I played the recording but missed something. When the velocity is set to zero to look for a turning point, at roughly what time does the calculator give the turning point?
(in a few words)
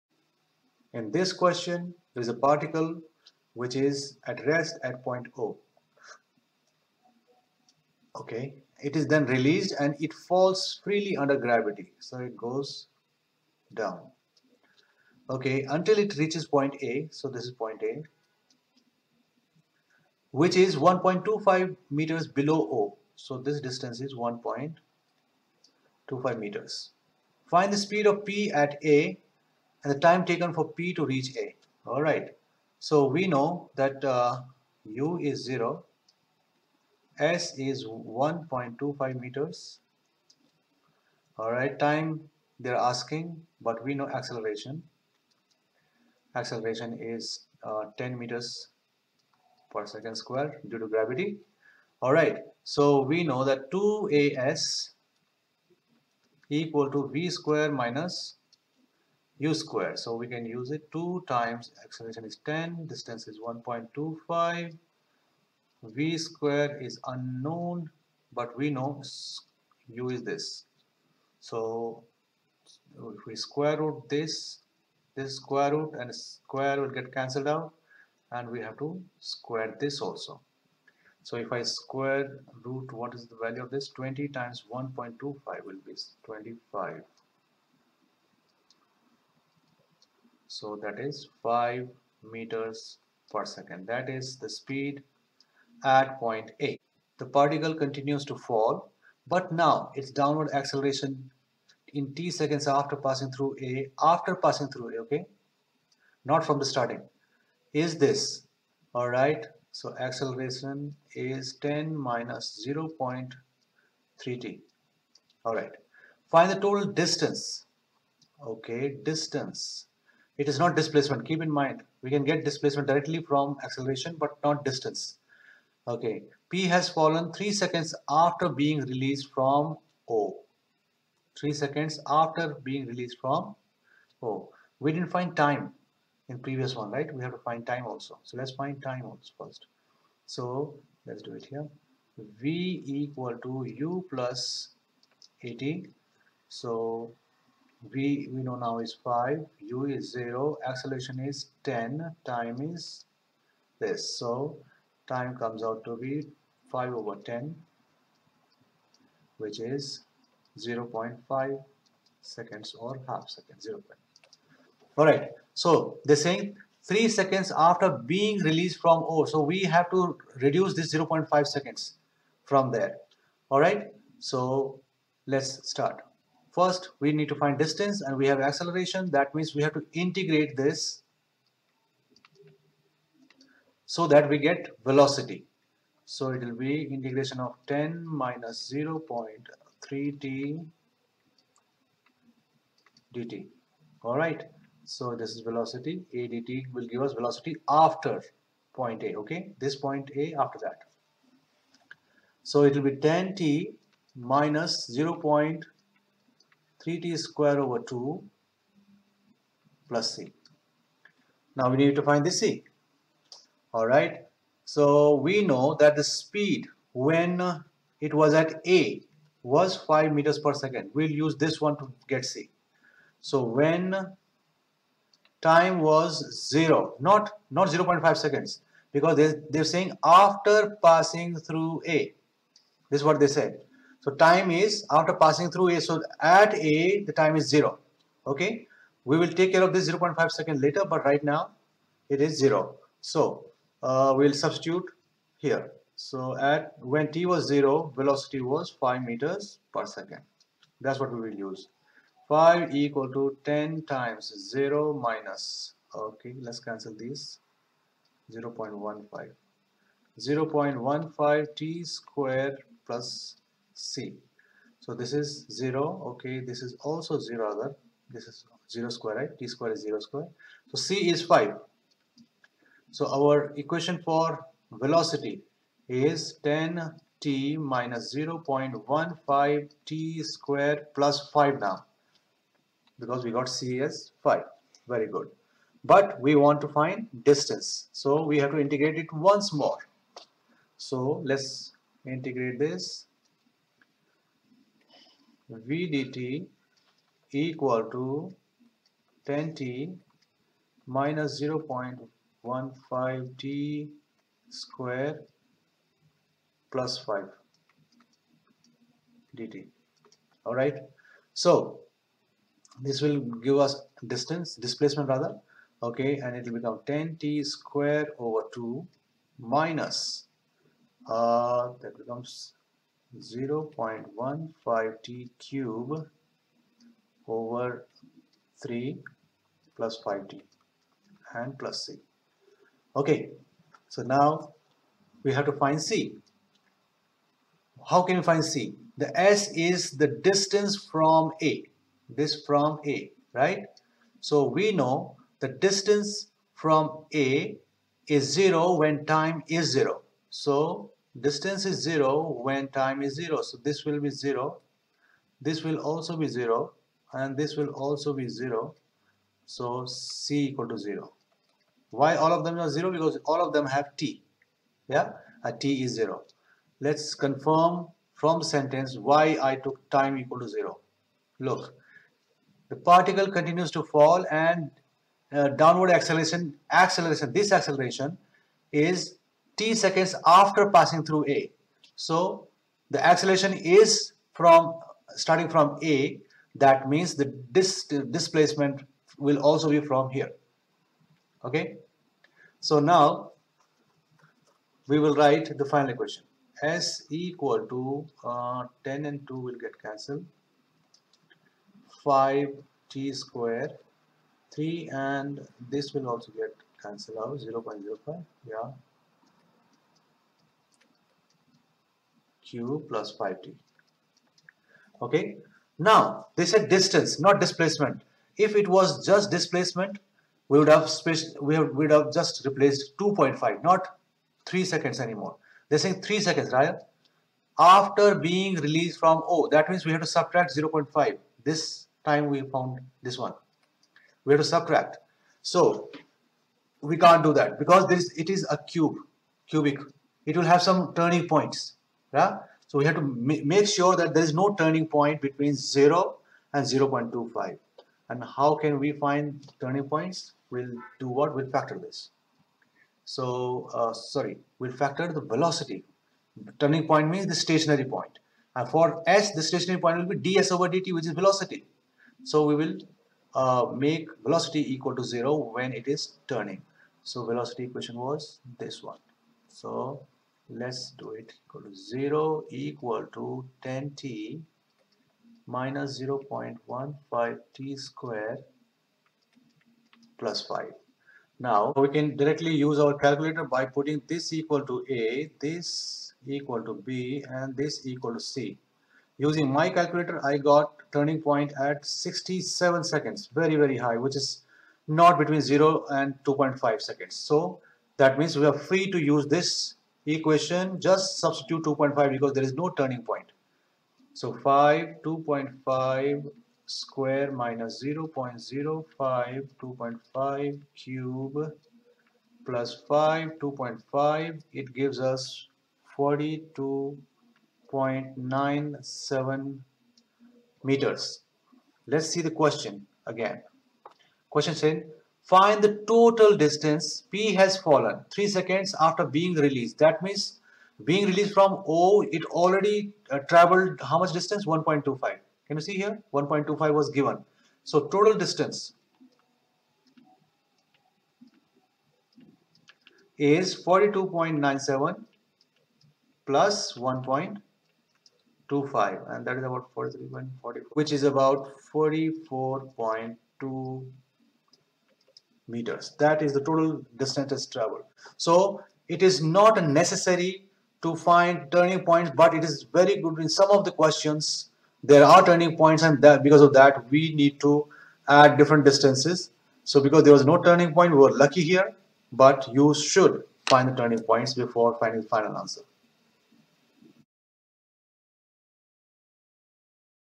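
67 seconds.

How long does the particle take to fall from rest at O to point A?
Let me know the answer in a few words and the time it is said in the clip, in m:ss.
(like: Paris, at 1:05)
0.5 seconds, at 2:40.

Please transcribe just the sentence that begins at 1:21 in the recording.
So if I square root, what is the value of this?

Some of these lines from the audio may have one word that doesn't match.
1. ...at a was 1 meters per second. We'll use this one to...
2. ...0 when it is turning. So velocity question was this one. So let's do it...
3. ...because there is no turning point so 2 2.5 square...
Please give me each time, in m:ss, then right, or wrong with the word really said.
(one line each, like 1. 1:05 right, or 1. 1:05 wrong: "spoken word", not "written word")
1. 3:38 wrong: "5", not "1"
2. 7:45 wrong: "equation", not "question"
3. 8:22 wrong: "5", not "2".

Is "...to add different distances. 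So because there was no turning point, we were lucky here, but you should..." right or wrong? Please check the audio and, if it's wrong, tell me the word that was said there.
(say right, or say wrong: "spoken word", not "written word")
right.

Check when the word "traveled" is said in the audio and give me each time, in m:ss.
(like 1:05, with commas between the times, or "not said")
8:53, 9:17.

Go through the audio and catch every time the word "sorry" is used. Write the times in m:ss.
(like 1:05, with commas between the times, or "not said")
7:33.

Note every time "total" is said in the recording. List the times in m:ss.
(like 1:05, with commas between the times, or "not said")
1:56, 8:45, 8:57, 9:16.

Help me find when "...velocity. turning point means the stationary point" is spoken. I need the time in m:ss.
7:35.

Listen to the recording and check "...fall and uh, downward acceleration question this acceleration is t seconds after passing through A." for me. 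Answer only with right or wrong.
wrong.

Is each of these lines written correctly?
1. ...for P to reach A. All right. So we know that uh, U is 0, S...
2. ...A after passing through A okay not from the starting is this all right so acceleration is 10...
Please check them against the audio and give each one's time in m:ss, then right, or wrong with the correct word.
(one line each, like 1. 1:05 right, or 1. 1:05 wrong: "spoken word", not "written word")
1. 0:30 right
2. 1:43 right.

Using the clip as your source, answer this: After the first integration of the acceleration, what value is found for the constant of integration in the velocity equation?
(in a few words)
5.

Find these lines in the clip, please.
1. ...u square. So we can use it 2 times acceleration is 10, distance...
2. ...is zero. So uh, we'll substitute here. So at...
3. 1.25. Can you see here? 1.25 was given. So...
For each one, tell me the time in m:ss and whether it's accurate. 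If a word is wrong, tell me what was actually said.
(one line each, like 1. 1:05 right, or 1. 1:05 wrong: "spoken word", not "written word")
1. 0:59 right
2. 4:02 right
3. 8:54 right.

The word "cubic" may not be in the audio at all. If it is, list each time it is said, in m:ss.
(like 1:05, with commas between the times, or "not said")
7:19.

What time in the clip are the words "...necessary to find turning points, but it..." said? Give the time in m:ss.
9:19.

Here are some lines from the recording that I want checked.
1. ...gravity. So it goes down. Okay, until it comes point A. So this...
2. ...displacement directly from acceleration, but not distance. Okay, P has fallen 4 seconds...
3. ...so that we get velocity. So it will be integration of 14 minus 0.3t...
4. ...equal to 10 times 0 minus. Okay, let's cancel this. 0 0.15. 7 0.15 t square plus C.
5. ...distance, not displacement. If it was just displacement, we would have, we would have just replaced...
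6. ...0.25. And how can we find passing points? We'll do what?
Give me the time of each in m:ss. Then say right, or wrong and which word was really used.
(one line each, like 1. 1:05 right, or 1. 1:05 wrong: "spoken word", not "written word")
1. 0:11 wrong: "reaches", not "comes"
2. 2:02 wrong: "3", not "4"
3. 3:03 wrong: "10", not "14"
4. 4:12 wrong: "0", not "7"
5. 6:56 right
6. 7:26 wrong: "turning", not "passing".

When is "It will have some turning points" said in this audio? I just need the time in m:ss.
7:20.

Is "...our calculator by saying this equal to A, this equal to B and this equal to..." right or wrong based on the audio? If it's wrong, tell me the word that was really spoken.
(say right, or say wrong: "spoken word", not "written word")
wrong: "putting", not "saying".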